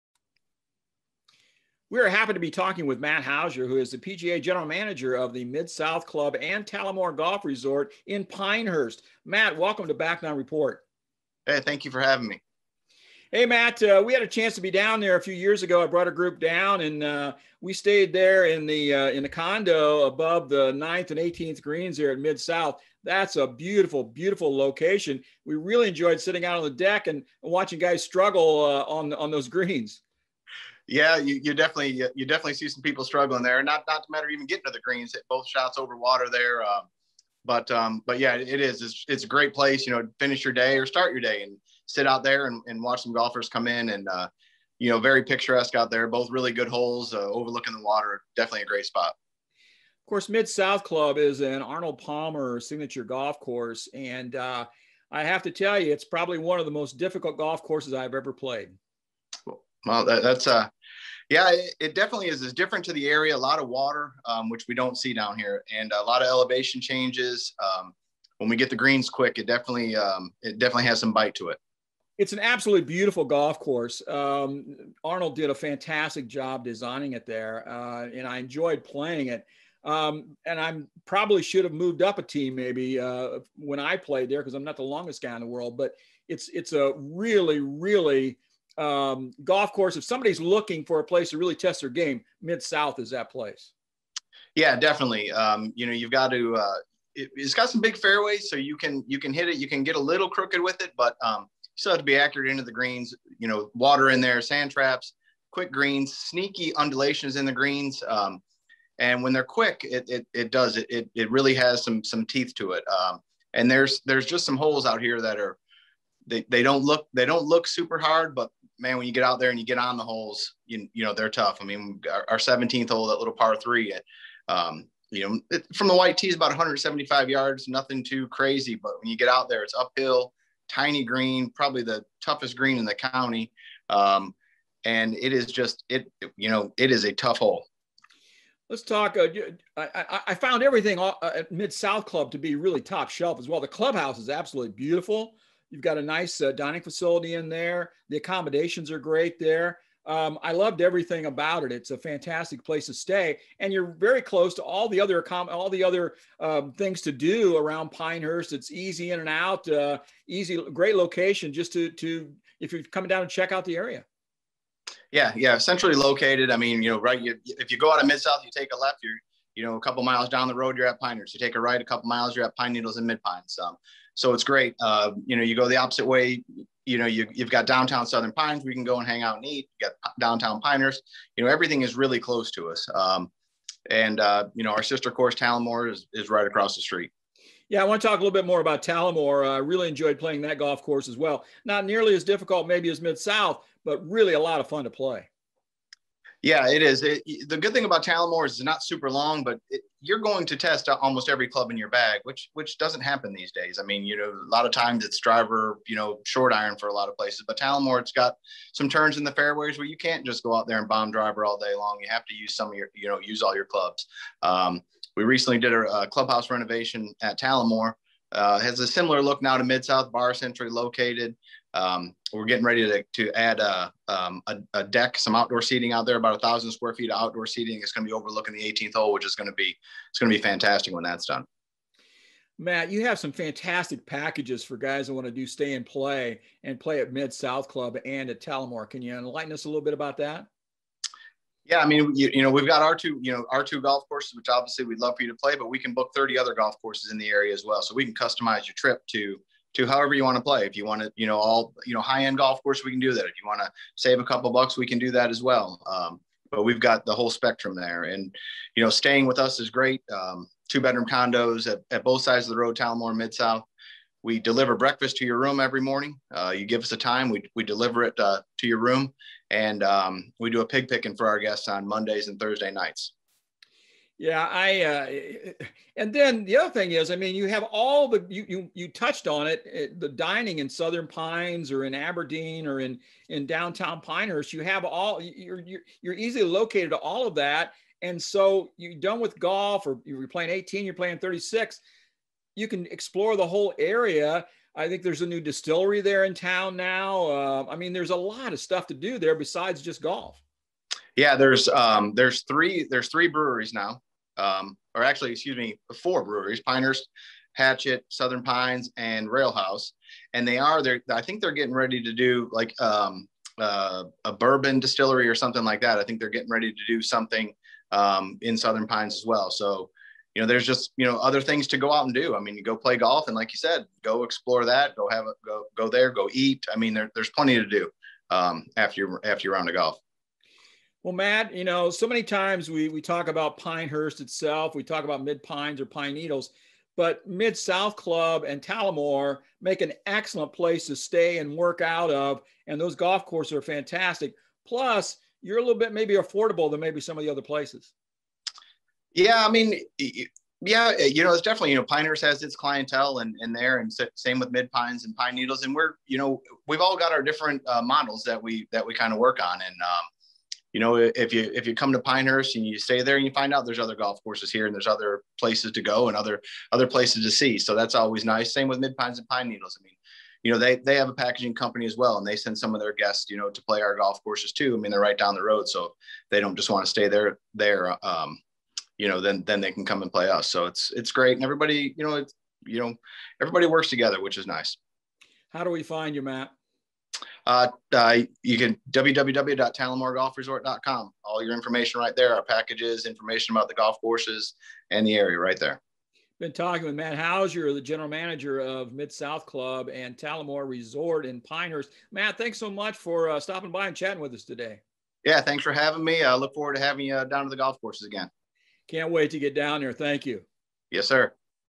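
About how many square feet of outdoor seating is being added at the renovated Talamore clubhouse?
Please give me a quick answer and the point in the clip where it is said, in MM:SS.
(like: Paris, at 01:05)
1,000, at 03:46.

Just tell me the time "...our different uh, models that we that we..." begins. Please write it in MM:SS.
05:57.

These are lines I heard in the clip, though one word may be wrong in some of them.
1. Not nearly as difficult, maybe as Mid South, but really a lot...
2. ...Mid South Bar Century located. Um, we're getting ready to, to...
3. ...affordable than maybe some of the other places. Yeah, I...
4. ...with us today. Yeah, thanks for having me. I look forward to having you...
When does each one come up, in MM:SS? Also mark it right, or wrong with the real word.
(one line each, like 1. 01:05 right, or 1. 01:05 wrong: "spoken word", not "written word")
1. 03:11 right
2. 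03:39 right
3. 05:46 right
4. 06:44 right.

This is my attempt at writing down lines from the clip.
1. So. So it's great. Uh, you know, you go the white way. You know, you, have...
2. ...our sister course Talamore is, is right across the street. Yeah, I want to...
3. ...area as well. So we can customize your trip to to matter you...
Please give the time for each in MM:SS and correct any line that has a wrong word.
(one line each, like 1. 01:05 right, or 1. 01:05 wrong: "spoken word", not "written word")
1. 02:53 wrong: "opposite", not "white"
2. 03:04 right
3. 04:07 wrong: "however", not "matter".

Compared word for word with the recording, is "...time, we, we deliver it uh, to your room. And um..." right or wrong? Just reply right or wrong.
right.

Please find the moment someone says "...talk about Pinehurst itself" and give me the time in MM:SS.
05:33.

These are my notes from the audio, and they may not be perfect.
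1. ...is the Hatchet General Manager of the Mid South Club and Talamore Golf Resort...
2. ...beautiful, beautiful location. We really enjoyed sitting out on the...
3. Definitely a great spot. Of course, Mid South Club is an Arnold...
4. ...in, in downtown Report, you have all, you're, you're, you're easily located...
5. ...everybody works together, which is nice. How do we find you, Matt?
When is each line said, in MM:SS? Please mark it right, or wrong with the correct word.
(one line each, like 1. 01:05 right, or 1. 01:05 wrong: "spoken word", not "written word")
1. 00:03 wrong: "PGA", not "Hatchet"
2. 00:23 right
3. 00:48 right
4. 04:42 wrong: "Pinehurst", not "Report"
5. 06:23 right.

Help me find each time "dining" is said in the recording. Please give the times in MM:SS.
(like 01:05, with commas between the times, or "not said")
02:26, 04:40.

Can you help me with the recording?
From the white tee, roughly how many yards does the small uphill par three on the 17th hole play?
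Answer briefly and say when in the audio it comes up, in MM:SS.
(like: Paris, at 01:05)
175 yards, at 02:06.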